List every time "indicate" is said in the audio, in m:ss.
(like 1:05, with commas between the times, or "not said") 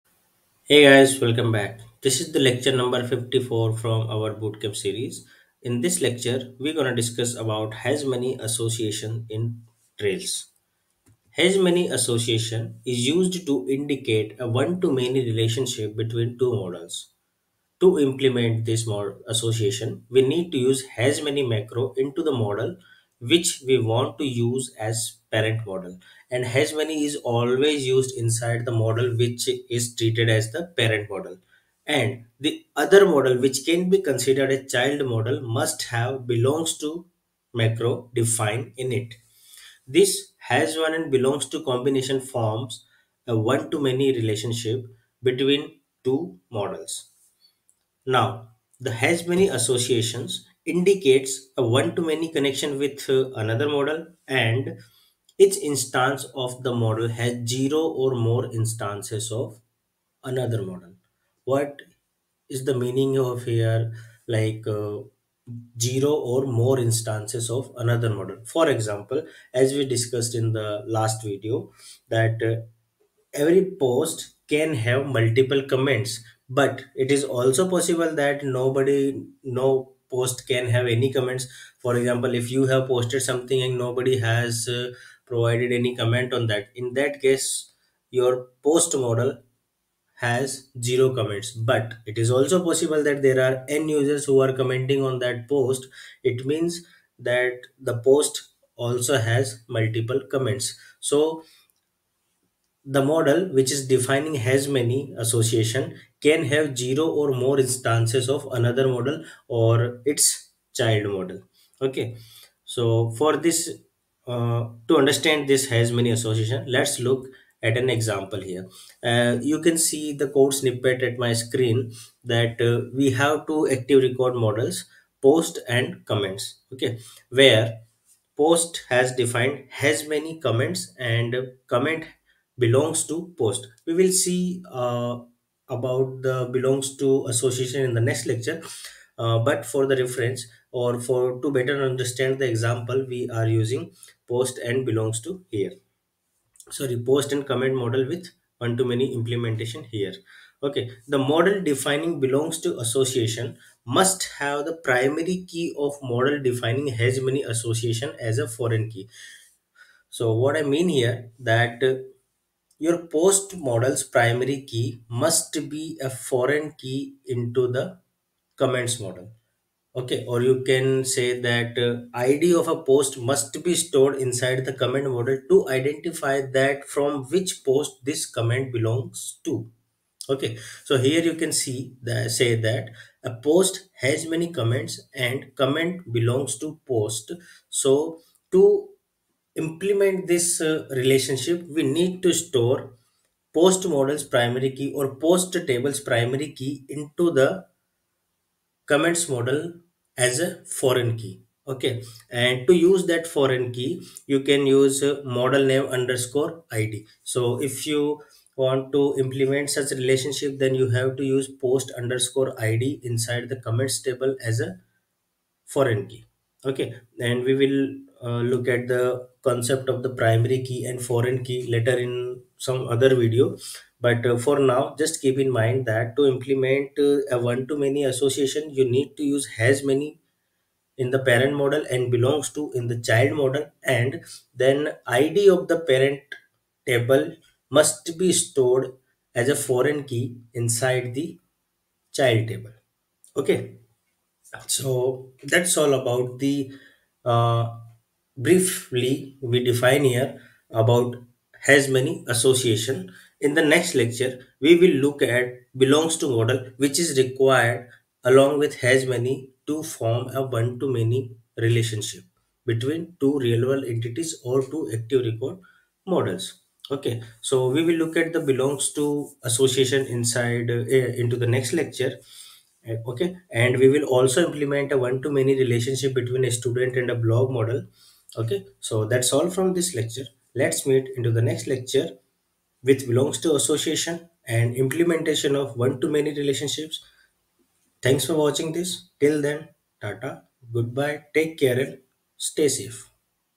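0:13, 0:50.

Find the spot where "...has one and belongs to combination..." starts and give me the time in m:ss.
0:40.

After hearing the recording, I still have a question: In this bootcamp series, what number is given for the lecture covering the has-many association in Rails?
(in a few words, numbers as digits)
54.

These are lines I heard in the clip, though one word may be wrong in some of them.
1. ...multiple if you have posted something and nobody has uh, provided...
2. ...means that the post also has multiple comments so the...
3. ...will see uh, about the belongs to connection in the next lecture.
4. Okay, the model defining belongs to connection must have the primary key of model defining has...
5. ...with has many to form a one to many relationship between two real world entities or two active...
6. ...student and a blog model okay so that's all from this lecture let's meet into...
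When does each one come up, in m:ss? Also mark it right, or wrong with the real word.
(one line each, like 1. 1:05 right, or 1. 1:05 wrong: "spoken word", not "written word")
1. 1:21 wrong: "example", not "multiple"
2. 1:36 right
3. 2:13 wrong: "association", not "connection"
4. 2:30 wrong: "association", not "connection"
5. 4:18 right
6. 4:36 right.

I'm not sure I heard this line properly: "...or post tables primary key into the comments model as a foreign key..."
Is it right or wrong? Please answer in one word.
right.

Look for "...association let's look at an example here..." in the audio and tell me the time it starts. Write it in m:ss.
1:56.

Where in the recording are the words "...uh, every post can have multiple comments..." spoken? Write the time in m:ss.
1:12.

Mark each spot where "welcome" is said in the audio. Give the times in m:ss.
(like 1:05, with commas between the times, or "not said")
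0:01.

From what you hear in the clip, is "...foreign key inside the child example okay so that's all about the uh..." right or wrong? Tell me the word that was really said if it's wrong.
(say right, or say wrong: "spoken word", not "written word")
wrong: "table", not "example".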